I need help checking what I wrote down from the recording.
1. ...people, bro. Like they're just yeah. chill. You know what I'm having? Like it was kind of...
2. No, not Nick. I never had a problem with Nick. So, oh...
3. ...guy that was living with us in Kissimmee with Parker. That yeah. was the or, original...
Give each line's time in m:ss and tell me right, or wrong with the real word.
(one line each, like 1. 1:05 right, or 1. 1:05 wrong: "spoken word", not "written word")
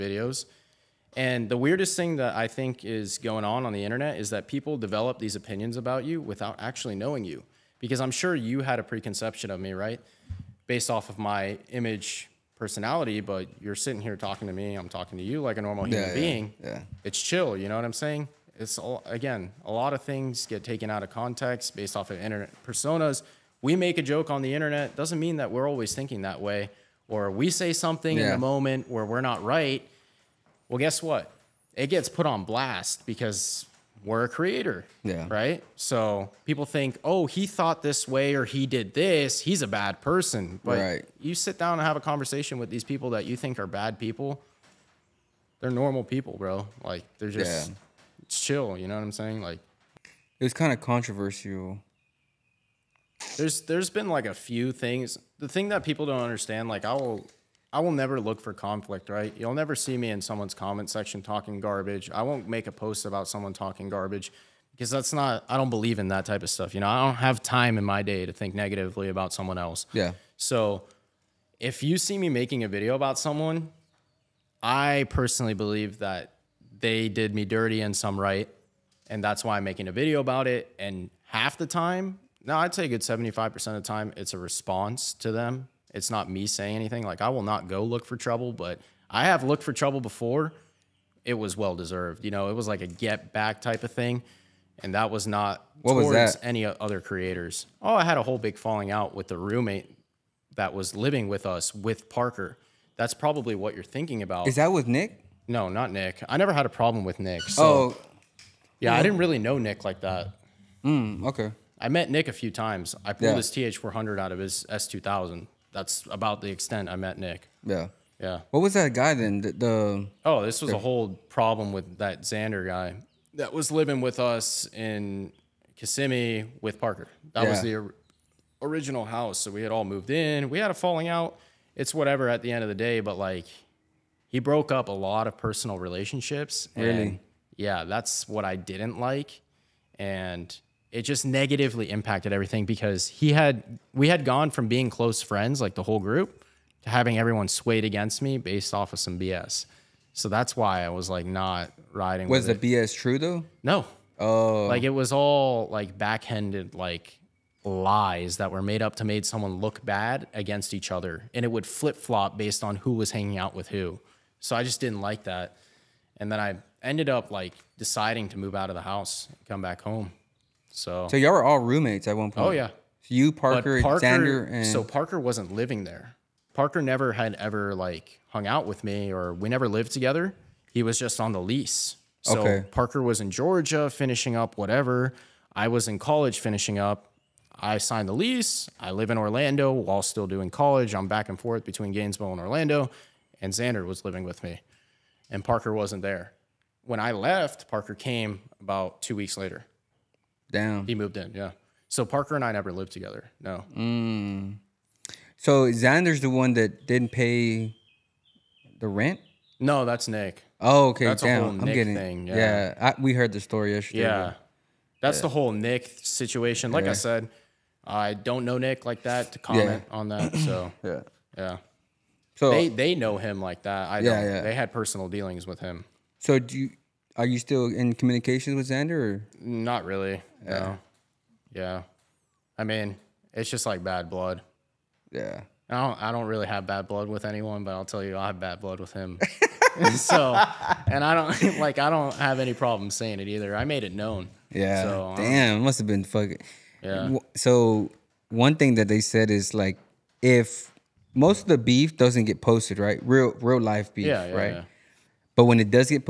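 1. 0:46 wrong: "saying", not "having"
2. 1:45 right
3. 2:02 right.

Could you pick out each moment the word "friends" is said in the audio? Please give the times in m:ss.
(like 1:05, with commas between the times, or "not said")
2:25.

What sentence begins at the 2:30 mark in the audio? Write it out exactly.
So that's why I was like not riding.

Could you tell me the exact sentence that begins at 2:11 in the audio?
It's whatever at the end of the day, but like he broke up a lot of personal relationships.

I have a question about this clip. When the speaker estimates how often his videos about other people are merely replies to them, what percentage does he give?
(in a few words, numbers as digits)
75%.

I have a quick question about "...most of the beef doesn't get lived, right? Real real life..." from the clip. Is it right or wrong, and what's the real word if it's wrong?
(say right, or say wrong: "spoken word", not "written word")
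wrong: "posted", not "lived".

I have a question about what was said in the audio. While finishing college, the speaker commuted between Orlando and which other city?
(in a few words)
Gainesville.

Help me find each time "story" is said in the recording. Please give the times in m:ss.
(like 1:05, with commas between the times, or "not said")
3:33.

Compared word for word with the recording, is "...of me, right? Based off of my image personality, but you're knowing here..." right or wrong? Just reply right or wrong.
wrong.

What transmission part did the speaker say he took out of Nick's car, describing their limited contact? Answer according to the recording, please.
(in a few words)
TH400.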